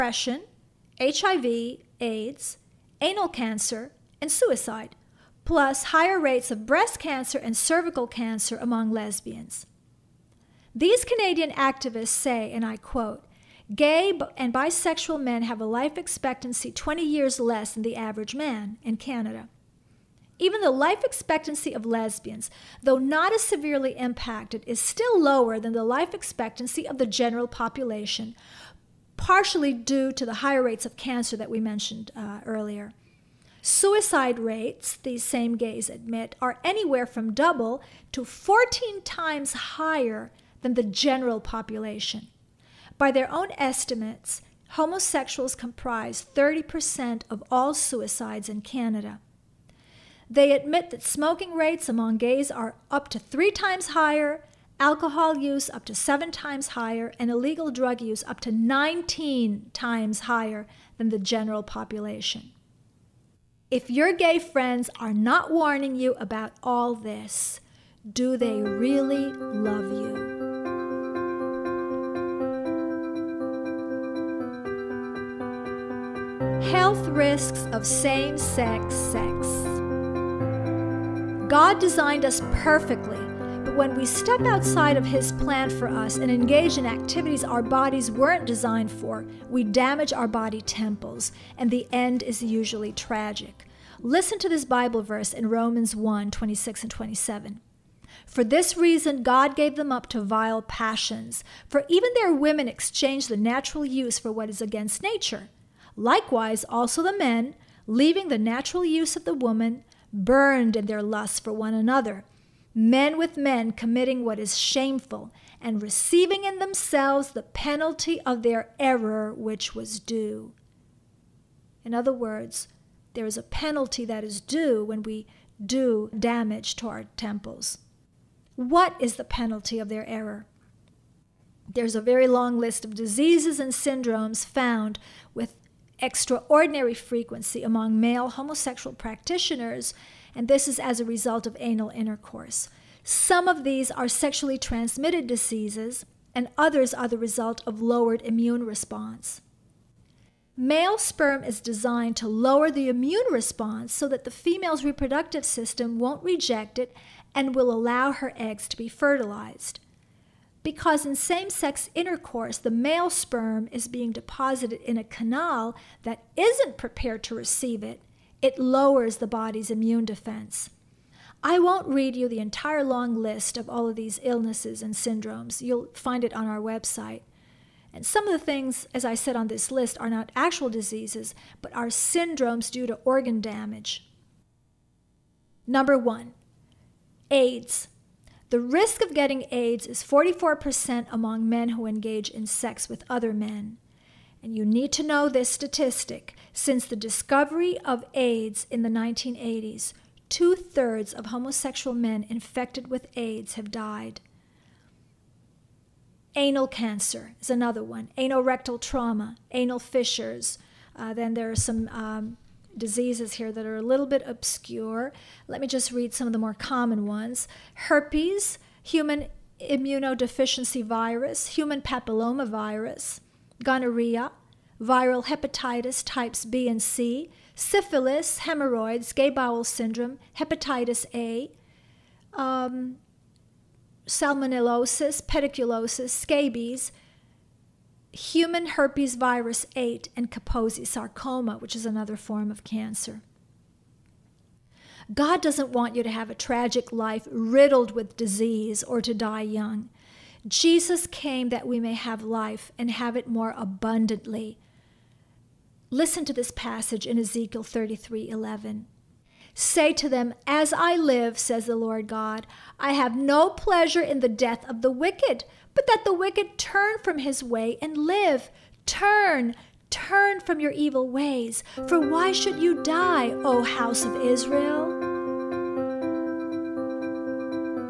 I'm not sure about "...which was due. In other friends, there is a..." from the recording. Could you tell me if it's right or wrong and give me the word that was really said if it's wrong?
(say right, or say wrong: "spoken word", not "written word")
wrong: "words", not "friends".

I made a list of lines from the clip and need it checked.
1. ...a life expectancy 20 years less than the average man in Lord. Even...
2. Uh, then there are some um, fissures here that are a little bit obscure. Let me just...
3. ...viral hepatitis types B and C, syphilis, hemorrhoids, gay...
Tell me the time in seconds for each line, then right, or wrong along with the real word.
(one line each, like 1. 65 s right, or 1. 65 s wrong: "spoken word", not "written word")
1. 15 s wrong: "Canada", not "Lord"
2. 210 s wrong: "diseases", not "fissures"
3. 224 s right.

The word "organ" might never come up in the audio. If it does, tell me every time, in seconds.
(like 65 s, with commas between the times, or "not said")
183 s.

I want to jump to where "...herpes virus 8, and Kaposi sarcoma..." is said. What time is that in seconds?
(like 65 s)
238 s.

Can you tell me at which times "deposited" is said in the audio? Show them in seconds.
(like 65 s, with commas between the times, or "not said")
164 s.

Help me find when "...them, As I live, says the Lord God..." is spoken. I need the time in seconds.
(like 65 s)
260 s.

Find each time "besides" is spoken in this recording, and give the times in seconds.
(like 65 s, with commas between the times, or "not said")
not said.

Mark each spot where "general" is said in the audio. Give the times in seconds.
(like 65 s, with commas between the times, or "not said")
27 s, 40 s, 61 s.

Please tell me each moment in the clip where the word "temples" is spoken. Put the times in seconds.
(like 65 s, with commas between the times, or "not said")
90 s, 127 s.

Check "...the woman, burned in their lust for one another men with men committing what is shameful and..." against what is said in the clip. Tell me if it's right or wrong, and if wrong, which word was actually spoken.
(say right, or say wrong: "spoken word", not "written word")
right.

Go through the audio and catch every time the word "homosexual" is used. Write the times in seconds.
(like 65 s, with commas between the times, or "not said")
44 s, 138 s, 201 s.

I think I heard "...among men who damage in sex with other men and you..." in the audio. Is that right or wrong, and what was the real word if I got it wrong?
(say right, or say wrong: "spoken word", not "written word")
wrong: "engage", not "damage".